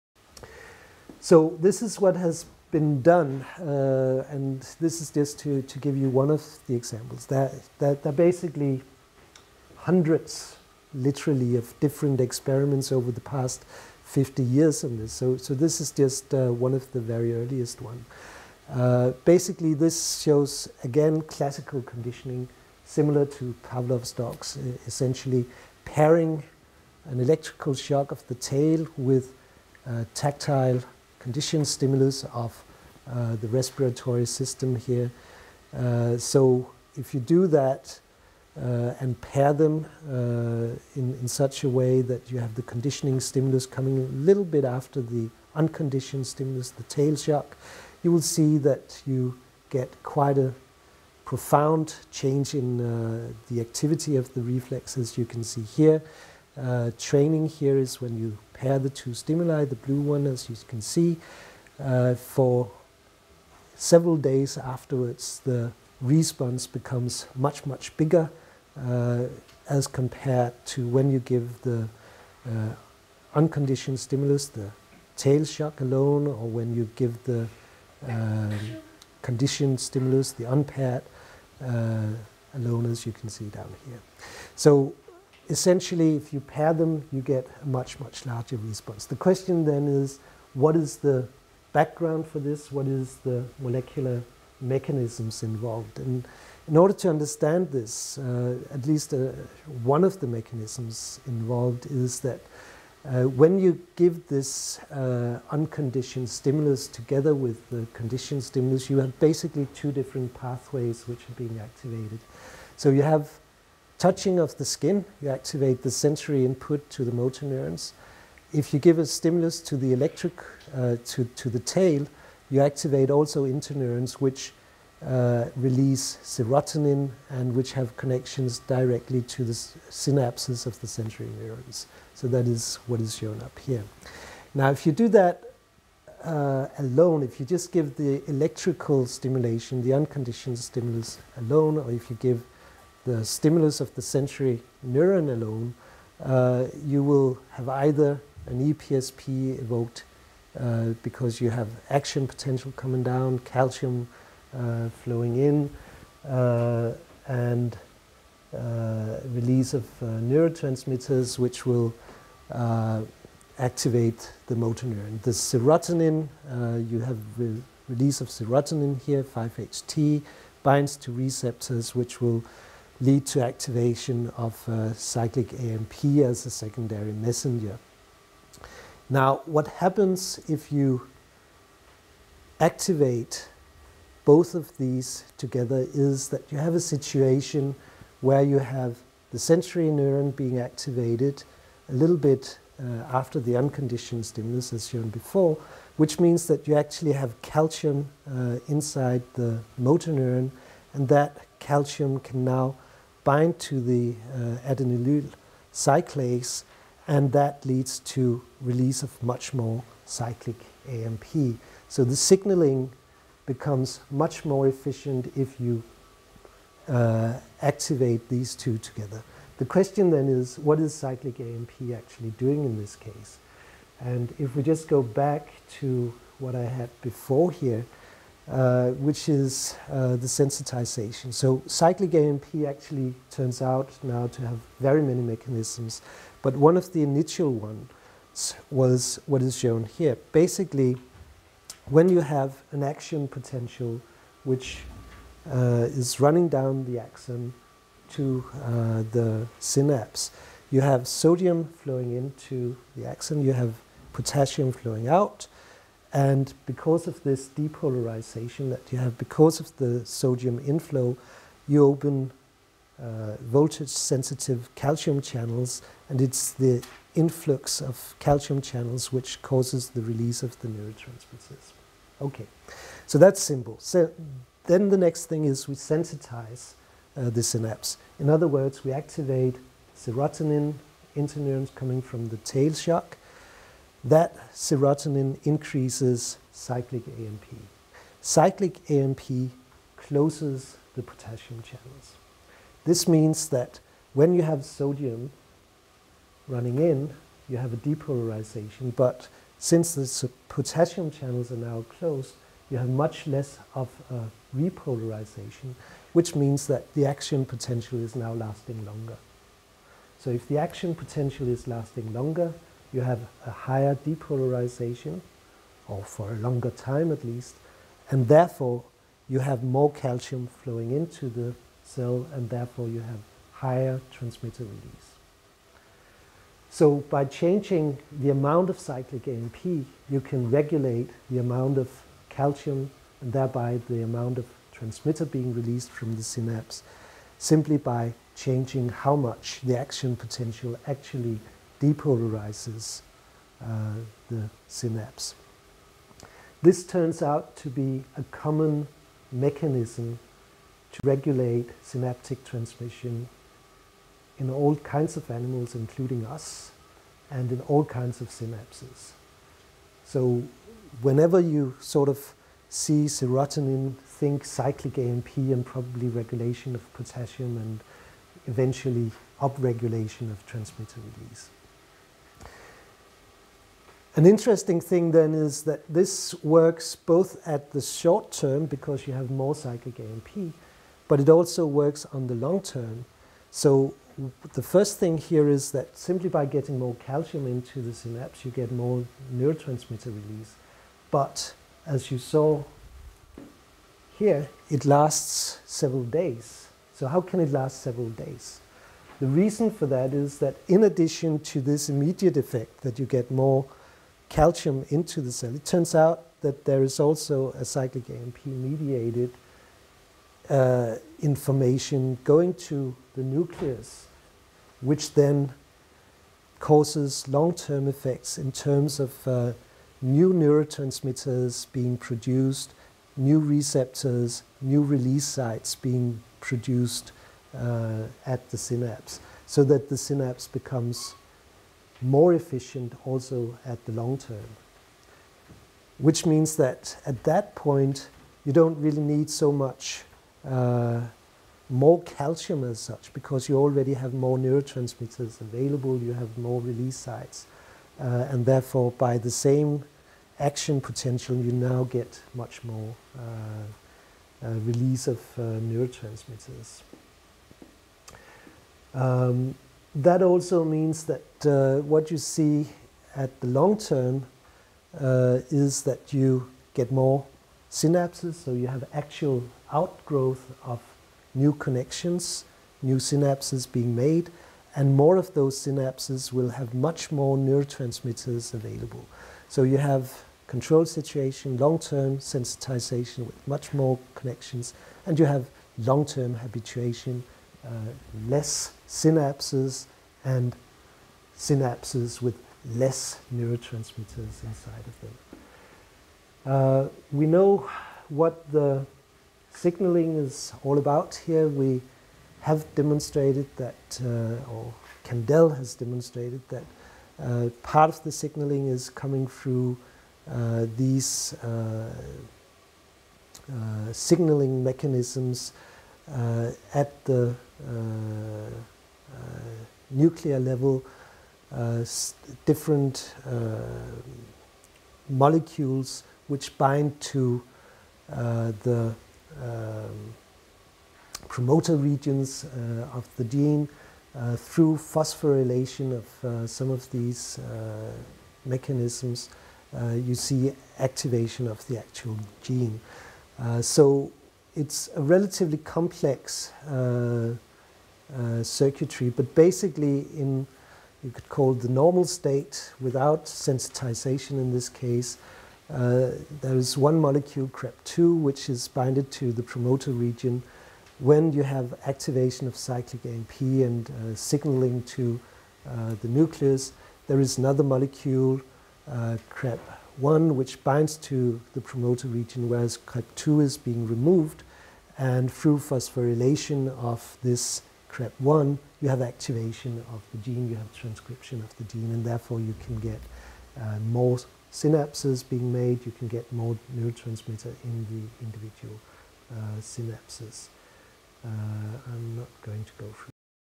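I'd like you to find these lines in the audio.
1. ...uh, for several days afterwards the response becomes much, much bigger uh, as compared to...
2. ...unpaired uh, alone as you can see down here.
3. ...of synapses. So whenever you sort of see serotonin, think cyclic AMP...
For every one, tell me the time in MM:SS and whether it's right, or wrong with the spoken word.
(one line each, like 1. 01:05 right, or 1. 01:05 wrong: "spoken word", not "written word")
1. 01:01 right
2. 01:20 right
3. 05:58 right.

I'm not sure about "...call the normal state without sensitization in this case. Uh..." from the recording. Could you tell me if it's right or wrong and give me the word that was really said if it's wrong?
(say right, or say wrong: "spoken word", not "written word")
right.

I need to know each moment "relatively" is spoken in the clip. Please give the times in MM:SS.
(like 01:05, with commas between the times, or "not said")
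09:05.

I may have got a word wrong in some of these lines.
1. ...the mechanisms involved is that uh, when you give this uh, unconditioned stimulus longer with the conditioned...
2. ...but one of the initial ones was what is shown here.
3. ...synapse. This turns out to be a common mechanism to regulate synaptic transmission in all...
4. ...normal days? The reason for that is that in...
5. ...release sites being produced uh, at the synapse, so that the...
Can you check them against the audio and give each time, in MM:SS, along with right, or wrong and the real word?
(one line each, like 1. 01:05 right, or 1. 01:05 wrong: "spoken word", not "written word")
1. 01:40 wrong: "together", not "longer"
2. 03:56 right
3. 05:44 right
4. 06:37 wrong: "several", not "normal"
5. 07:04 right.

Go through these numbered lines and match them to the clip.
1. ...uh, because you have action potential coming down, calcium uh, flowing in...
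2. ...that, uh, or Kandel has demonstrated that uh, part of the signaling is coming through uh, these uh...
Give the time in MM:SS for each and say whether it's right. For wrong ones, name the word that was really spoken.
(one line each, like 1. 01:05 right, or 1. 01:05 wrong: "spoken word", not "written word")
1. 02:30 right
2. 08:23 right.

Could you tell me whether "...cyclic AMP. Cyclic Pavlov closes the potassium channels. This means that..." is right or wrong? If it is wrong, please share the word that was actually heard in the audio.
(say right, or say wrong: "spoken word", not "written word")
wrong: "AMP", not "Pavlov".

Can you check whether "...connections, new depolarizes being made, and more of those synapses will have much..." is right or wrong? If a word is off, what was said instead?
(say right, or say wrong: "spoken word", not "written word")
wrong: "synapses", not "depolarizes".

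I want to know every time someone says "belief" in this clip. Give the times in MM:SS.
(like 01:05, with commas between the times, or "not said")
not said.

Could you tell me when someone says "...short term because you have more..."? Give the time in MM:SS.
06:17.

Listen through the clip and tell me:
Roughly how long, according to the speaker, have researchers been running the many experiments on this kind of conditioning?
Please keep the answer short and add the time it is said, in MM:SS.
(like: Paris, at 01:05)
50 years, at 00:14.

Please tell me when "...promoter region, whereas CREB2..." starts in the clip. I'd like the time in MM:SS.
09:31.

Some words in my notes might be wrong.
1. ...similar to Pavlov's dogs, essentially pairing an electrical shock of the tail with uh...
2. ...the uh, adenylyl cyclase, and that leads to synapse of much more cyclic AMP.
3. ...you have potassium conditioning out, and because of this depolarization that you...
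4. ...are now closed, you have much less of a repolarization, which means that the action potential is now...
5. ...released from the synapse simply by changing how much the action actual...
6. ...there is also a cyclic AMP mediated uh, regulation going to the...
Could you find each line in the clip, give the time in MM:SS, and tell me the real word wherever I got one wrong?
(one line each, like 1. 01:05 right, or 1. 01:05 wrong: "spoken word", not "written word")
1. 00:22 right
2. 03:23 wrong: "release", not "synapse"
3. 04:13 wrong: "flowing", not "conditioning"
4. 05:01 right
5. 05:35 wrong: "potential", not "actual"
6. 06:46 wrong: "information", not "regulation".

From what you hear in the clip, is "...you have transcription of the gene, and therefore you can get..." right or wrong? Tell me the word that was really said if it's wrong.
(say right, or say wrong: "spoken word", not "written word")
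right.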